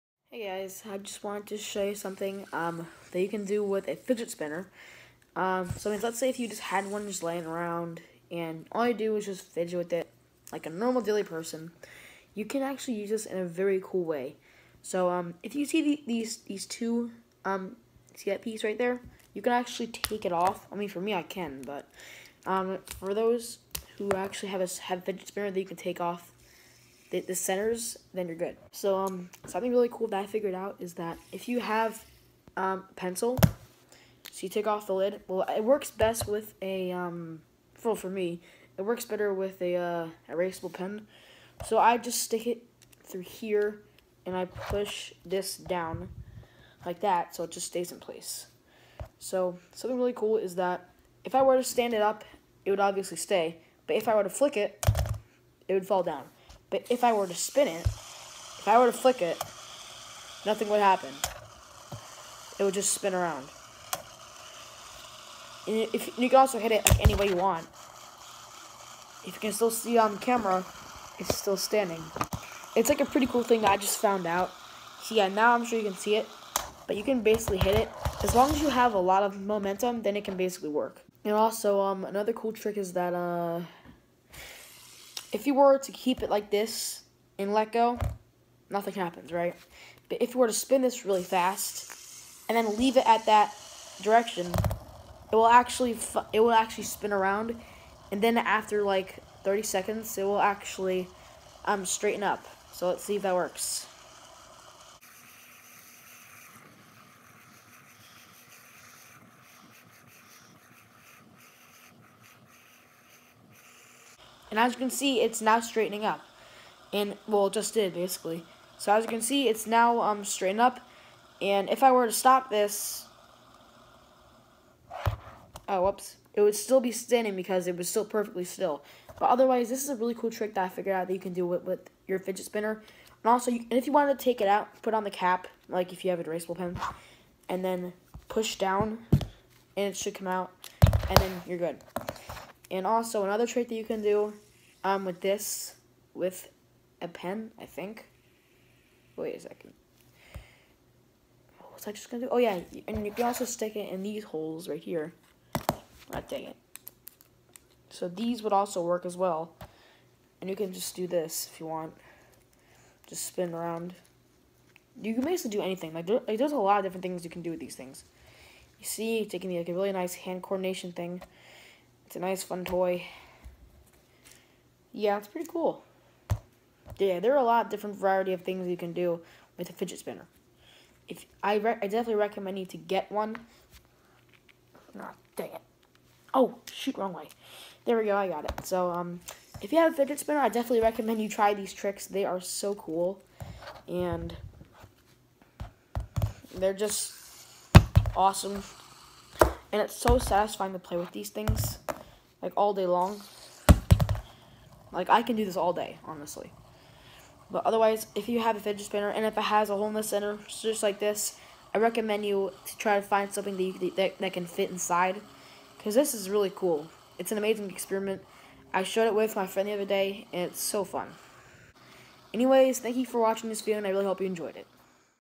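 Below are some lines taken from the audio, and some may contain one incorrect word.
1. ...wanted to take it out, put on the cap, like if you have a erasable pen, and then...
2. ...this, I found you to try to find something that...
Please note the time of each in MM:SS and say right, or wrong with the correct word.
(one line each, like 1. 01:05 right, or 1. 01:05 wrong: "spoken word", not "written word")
1. 02:13 right
2. 03:30 wrong: "recommend", not "found".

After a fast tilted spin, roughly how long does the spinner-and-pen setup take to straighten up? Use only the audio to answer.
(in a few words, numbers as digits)
30 seconds.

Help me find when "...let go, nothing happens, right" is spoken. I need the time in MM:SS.
01:27.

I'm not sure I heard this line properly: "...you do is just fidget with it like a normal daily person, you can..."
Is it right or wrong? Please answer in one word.
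right.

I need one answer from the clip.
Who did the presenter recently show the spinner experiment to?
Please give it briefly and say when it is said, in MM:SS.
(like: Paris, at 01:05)
Friend, at 03:39.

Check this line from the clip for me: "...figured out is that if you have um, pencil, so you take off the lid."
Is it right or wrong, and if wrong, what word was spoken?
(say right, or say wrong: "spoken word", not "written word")
right.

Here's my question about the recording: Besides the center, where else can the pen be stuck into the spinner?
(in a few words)
These holes.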